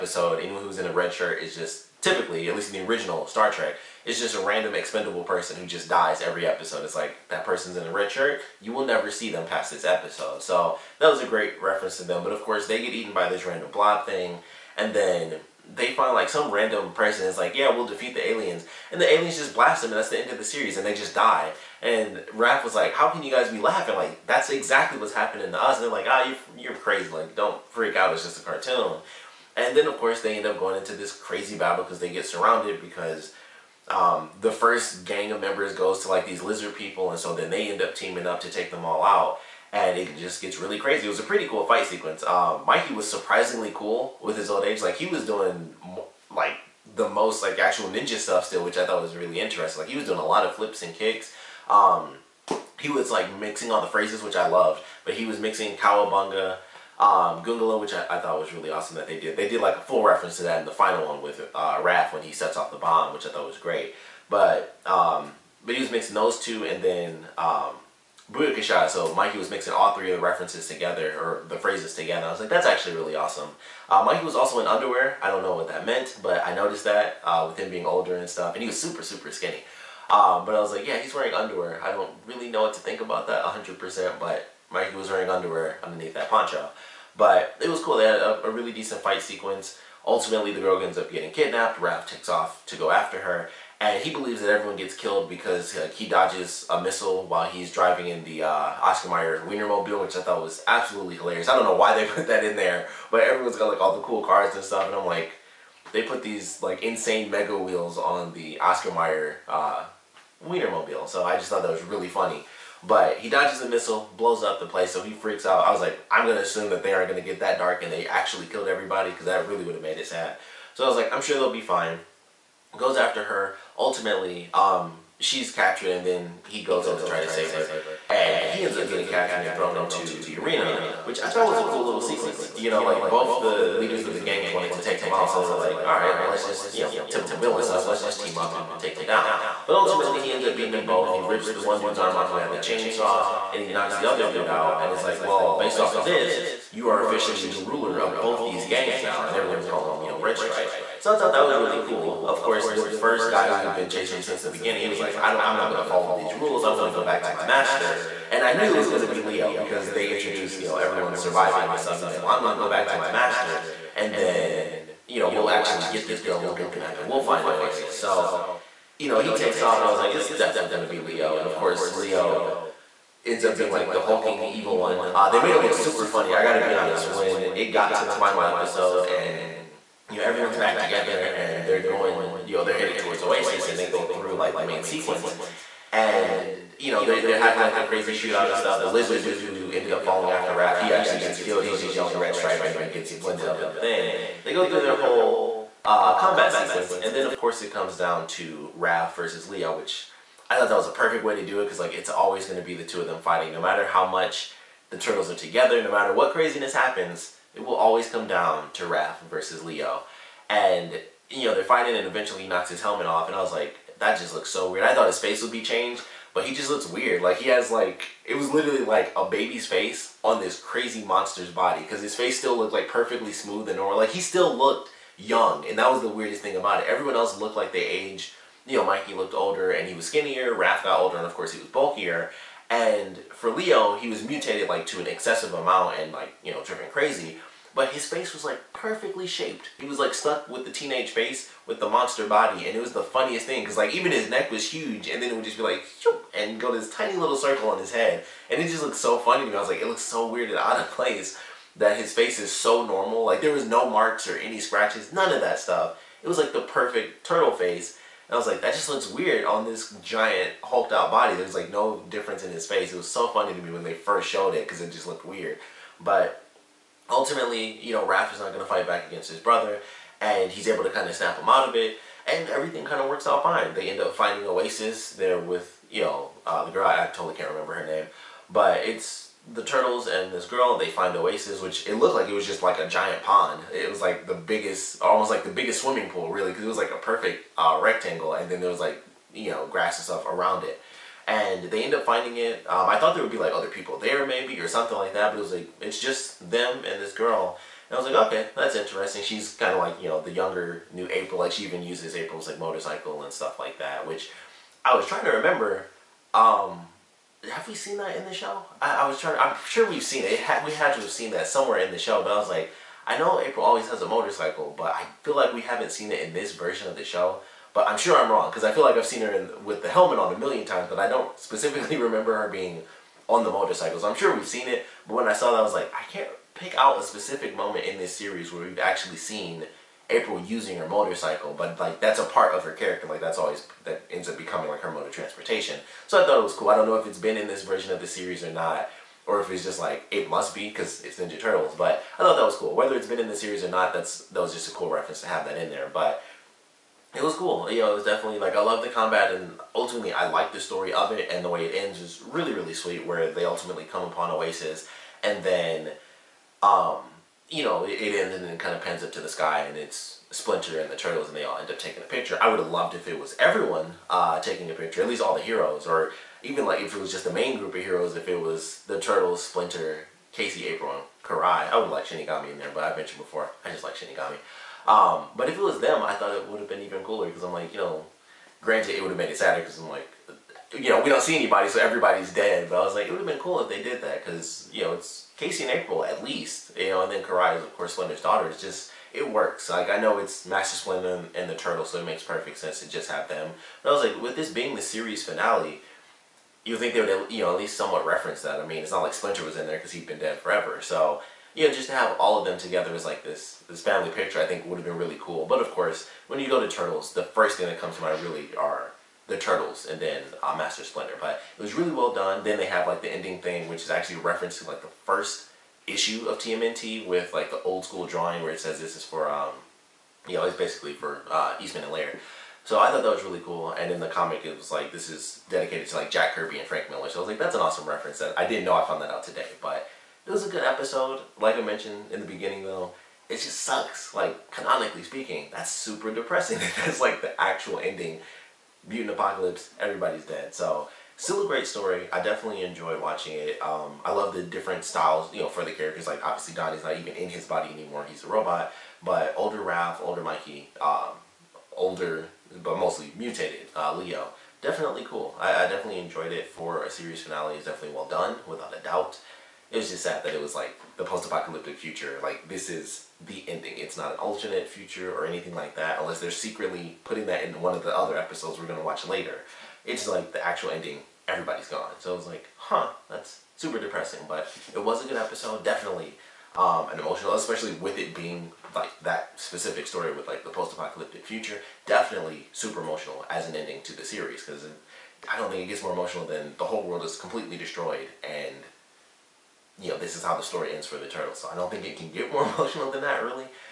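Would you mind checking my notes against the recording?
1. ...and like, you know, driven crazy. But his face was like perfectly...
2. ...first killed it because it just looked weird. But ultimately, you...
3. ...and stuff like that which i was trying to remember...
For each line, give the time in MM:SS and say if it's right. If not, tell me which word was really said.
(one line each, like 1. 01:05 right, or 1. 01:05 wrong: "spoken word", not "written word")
1. 03:55 right
2. 04:23 wrong: "showed", not "killed"
3. 05:03 right.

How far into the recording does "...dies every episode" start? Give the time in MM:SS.
00:05.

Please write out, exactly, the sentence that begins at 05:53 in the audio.
Where they ultimately come upon Oasis and then.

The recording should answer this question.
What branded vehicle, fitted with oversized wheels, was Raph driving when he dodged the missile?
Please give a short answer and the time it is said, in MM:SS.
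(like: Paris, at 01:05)
Oscar Mayer Wienermobile, at 01:38.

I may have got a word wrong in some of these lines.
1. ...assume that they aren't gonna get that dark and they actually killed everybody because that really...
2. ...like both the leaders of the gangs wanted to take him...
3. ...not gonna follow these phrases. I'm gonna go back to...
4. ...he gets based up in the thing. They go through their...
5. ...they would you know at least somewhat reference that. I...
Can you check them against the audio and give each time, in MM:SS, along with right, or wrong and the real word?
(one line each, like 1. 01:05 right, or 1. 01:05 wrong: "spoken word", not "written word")
1. 01:56 right
2. 02:12 right
3. 02:35 wrong: "rules", not "phrases"
4. 03:12 wrong: "blended", not "based"
5. 06:36 right.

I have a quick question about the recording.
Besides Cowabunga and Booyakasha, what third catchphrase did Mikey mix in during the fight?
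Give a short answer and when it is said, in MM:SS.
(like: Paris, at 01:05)
Goongala, at 00:57.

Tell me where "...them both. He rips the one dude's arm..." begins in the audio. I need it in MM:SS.
02:20.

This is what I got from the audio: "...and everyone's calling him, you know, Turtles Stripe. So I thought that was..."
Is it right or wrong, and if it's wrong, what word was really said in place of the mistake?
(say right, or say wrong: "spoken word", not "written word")
wrong: "Red", not "Turtles".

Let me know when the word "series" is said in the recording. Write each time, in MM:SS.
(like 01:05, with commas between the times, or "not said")
00:20, 05:28, 05:38, 05:43, 06:34, 07:36, 08:04.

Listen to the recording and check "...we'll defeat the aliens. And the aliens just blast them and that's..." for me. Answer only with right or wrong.
right.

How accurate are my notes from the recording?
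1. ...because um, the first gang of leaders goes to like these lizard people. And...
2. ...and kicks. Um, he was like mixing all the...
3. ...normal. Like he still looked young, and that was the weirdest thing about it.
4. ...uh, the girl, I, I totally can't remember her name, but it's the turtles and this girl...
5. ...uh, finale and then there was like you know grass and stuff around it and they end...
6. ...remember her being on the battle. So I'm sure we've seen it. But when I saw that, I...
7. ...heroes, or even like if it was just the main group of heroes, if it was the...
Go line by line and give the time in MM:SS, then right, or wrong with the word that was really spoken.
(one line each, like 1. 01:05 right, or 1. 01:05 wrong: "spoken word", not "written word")
1. 00:32 wrong: "members", not "leaders"
2. 00:50 right
3. 03:43 right
4. 04:36 right
5. 04:47 wrong: "rectangle", not "finale"
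6. 05:21 wrong: "motorcycle", not "battle"
7. 06:05 right.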